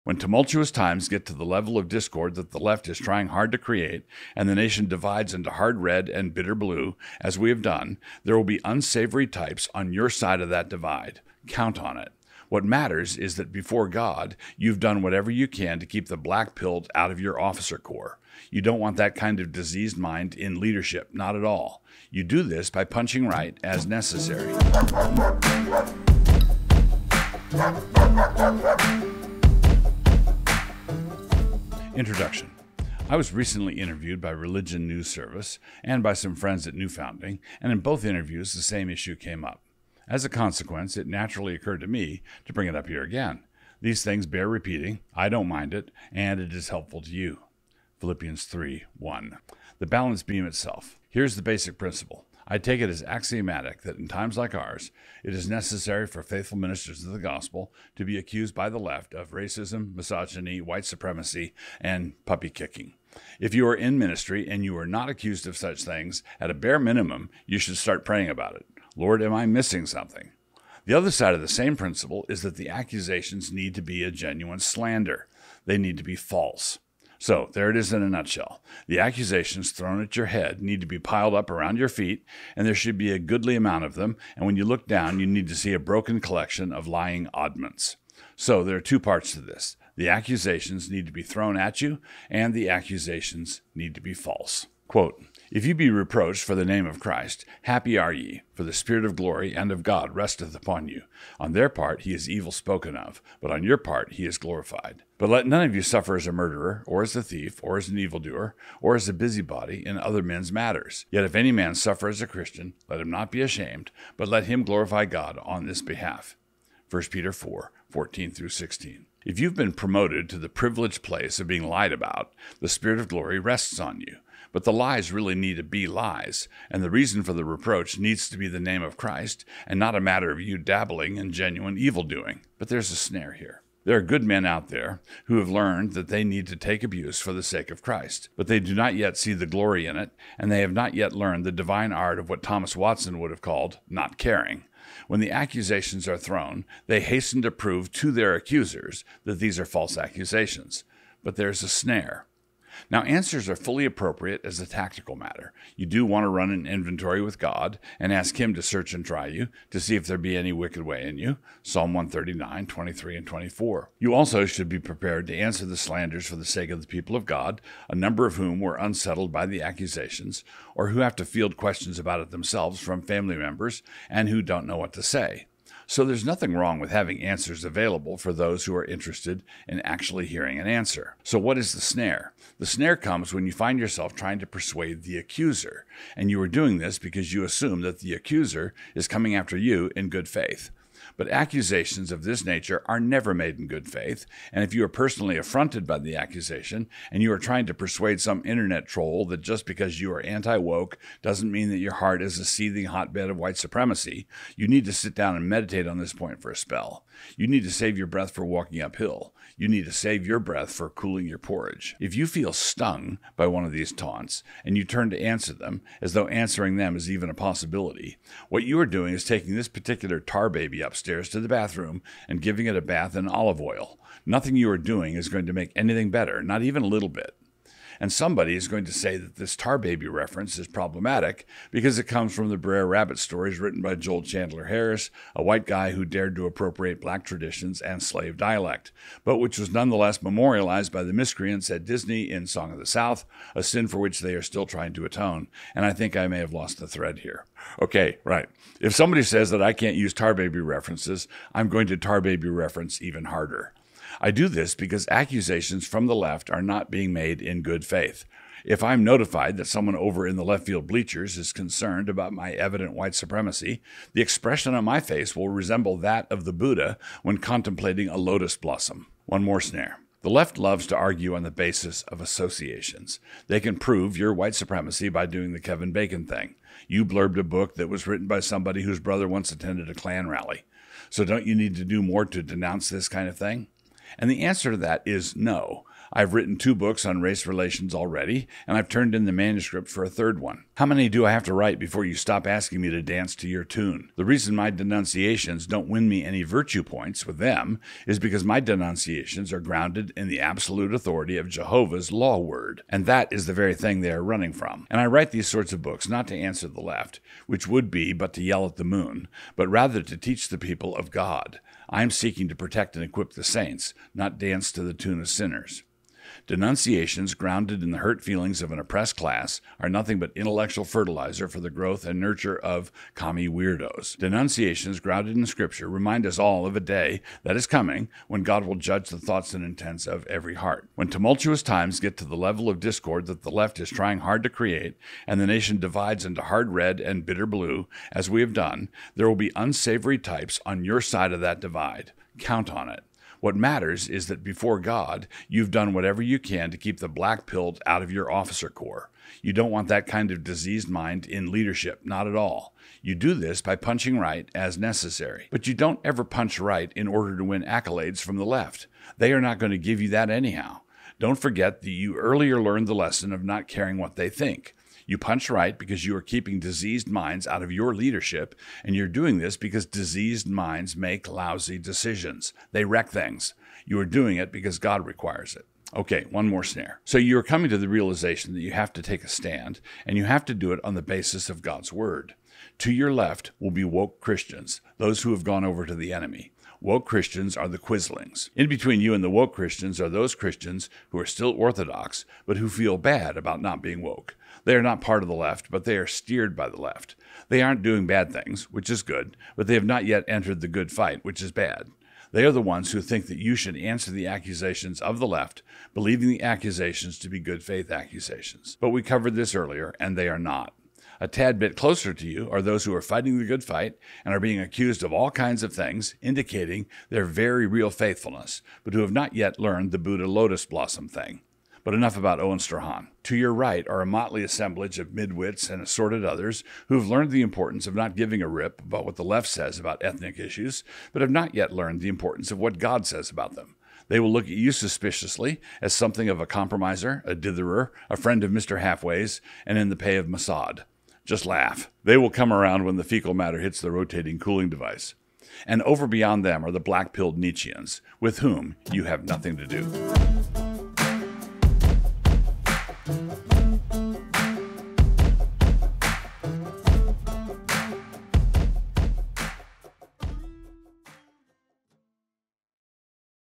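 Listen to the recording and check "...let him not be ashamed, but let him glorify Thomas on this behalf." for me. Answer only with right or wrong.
wrong.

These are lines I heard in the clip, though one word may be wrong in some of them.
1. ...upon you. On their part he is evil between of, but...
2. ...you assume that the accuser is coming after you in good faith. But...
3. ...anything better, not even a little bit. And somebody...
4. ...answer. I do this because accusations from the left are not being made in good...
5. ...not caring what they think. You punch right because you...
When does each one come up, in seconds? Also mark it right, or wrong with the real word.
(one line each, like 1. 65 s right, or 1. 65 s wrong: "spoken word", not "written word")
1. 100 s wrong: "spoken", not "between"
2. 187 s right
3. 225 s right
4. 253 s wrong: "harder", not "answer"
5. 363 s right.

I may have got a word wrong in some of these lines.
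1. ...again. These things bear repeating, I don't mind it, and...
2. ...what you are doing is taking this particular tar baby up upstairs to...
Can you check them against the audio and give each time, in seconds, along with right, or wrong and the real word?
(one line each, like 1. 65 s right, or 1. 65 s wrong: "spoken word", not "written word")
1. 43 s right
2. 218 s right.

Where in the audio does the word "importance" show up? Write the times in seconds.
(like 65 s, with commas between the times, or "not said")
427 s, 432 s.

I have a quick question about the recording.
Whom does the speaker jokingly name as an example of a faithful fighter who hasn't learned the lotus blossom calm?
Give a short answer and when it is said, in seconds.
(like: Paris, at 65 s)
Owen Strahan, at 422 s.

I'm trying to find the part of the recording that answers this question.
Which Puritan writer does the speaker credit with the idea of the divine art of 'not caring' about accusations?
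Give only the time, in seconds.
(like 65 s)
142 s.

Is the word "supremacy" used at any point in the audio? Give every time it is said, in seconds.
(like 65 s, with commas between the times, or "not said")
60 s, 203 s, 263 s, 274 s.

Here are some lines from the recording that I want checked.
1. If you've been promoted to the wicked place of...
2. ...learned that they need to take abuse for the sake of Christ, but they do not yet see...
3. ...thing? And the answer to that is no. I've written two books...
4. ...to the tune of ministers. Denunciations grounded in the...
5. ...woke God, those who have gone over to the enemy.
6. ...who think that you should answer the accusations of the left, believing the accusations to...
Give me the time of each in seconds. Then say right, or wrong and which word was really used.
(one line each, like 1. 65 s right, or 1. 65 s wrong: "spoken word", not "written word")
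1. 119 s wrong: "privileged", not "wicked"
2. 135 s right
3. 283 s right
4. 314 s wrong: "sinners", not "ministers"
5. 383 s wrong: "Christians", not "God"
6. 402 s right.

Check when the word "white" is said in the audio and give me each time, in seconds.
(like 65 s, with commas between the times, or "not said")
60 s, 203 s, 235 s, 262 s, 274 s.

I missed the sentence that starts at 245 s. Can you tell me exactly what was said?
And I think I may have lost the thread here.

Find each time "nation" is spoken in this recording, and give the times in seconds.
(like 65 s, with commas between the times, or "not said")
4 s, 335 s.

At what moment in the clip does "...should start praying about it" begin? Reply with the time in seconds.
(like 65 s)
67 s.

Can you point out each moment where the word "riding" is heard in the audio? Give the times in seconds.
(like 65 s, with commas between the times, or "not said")
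not said.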